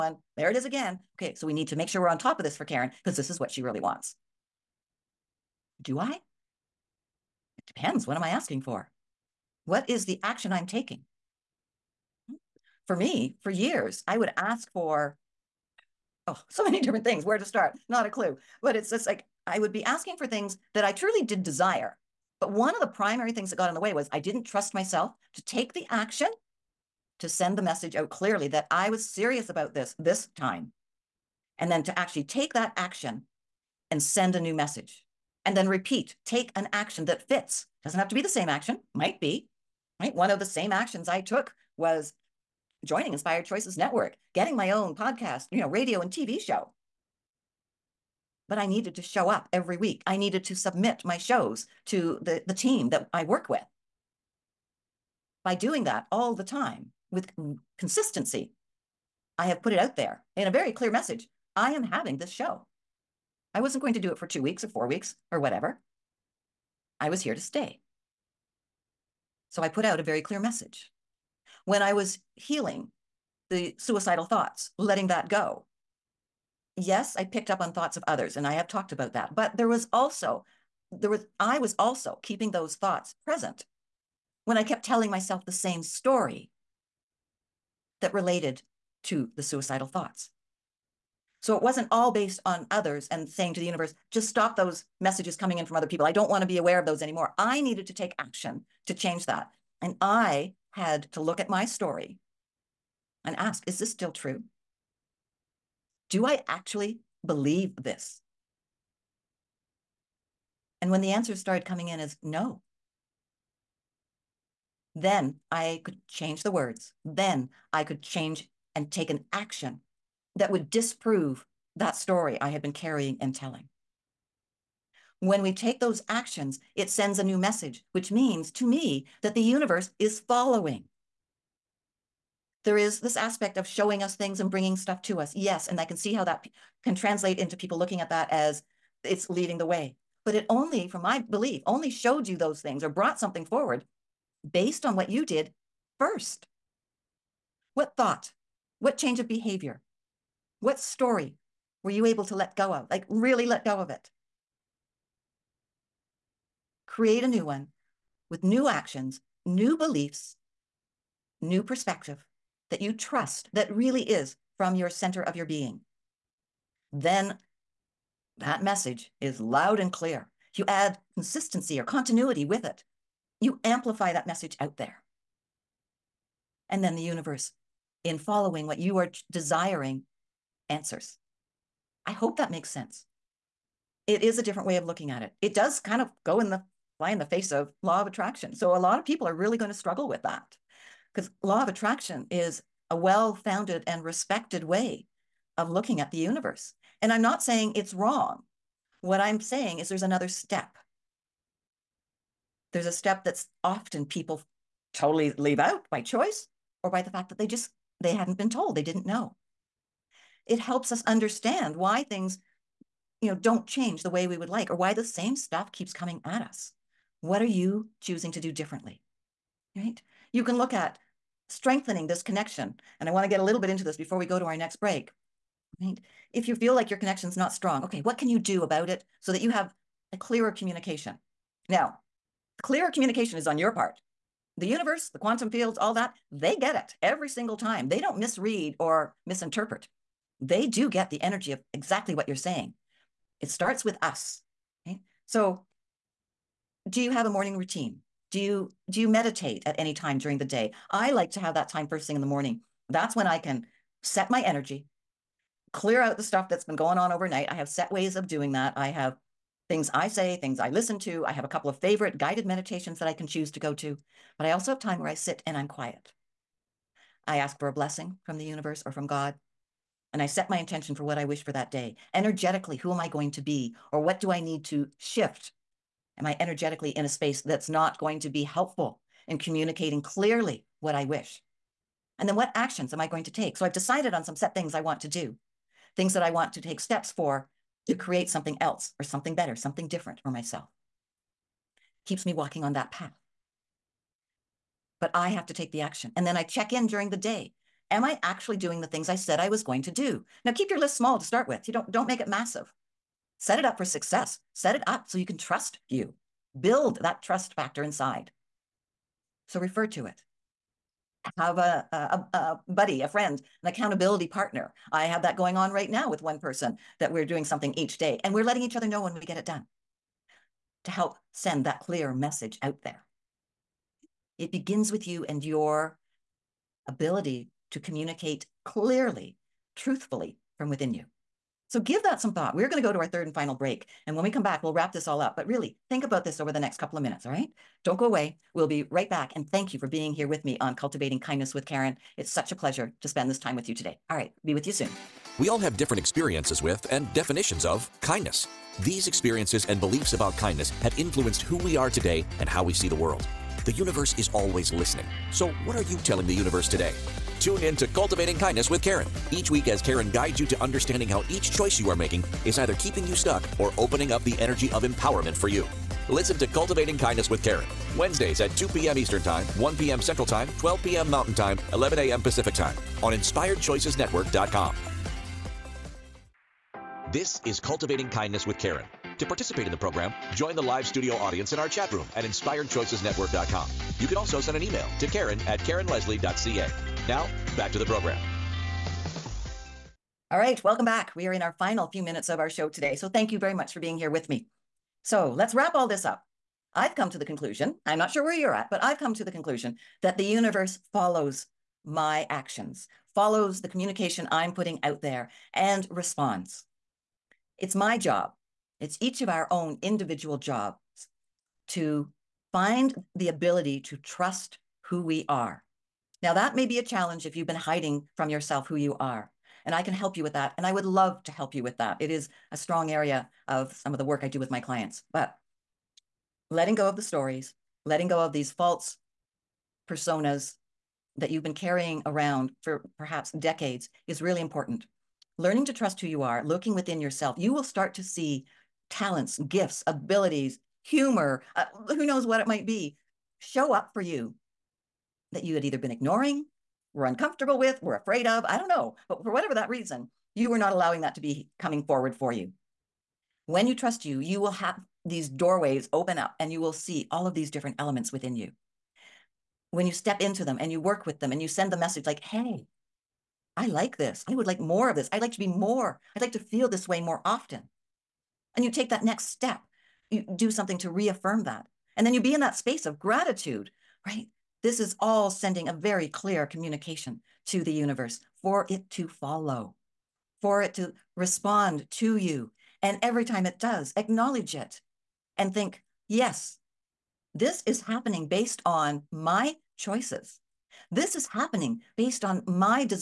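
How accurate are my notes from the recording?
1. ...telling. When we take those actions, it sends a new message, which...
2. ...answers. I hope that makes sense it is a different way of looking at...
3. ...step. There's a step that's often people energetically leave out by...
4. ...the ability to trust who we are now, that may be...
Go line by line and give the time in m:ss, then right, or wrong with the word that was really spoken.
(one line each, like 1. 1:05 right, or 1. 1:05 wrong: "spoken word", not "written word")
1. 2:03 right
2. 3:00 right
3. 3:20 wrong: "totally", not "energetically"
4. 6:53 right.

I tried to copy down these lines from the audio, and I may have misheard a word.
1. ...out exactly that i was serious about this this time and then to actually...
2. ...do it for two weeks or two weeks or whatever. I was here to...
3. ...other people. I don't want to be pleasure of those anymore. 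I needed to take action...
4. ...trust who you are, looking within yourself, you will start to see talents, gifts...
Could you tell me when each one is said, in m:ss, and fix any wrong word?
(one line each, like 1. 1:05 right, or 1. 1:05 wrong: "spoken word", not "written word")
1. 0:27 wrong: "clearly", not "exactly"
2. 1:03 wrong: "four", not "two"
3. 1:35 wrong: "aware", not "pleasure"
4. 7:15 right.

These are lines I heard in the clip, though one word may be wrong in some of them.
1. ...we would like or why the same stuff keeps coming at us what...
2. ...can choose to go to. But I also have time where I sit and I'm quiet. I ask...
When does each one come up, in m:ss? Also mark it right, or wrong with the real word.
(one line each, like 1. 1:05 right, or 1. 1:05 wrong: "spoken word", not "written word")
1. 3:34 right
2. 4:23 right.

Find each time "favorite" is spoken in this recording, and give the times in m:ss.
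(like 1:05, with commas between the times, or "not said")
4:21.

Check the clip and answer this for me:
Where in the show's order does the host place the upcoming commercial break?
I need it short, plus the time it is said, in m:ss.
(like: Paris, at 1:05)
Third and final, at 5:33.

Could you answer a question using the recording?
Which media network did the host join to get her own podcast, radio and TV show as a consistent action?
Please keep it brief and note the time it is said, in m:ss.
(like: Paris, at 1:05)
Inspired Choices Network, at 0:43.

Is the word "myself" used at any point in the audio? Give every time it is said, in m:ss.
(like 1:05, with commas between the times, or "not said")
0:24, 1:25, 4:50.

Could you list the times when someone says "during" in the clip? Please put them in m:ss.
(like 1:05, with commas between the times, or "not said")
4:10, 4:56.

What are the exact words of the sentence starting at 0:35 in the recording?
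And then repeat, take an action that fits.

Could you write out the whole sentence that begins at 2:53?
You amplify that message out there.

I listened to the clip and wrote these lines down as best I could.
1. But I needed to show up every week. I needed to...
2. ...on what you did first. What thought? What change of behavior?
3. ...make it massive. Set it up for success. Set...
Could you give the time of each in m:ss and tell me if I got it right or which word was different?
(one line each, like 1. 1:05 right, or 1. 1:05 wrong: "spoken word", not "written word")
1. 0:48 right
2. 2:24 right
3. 5:02 right.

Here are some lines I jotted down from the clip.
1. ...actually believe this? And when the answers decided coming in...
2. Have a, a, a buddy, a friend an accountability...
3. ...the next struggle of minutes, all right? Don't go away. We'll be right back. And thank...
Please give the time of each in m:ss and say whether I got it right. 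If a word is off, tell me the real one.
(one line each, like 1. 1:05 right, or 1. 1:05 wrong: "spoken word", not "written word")
1. 1:46 wrong: "started", not "decided"
2. 5:11 right
3. 5:36 wrong: "couple", not "struggle".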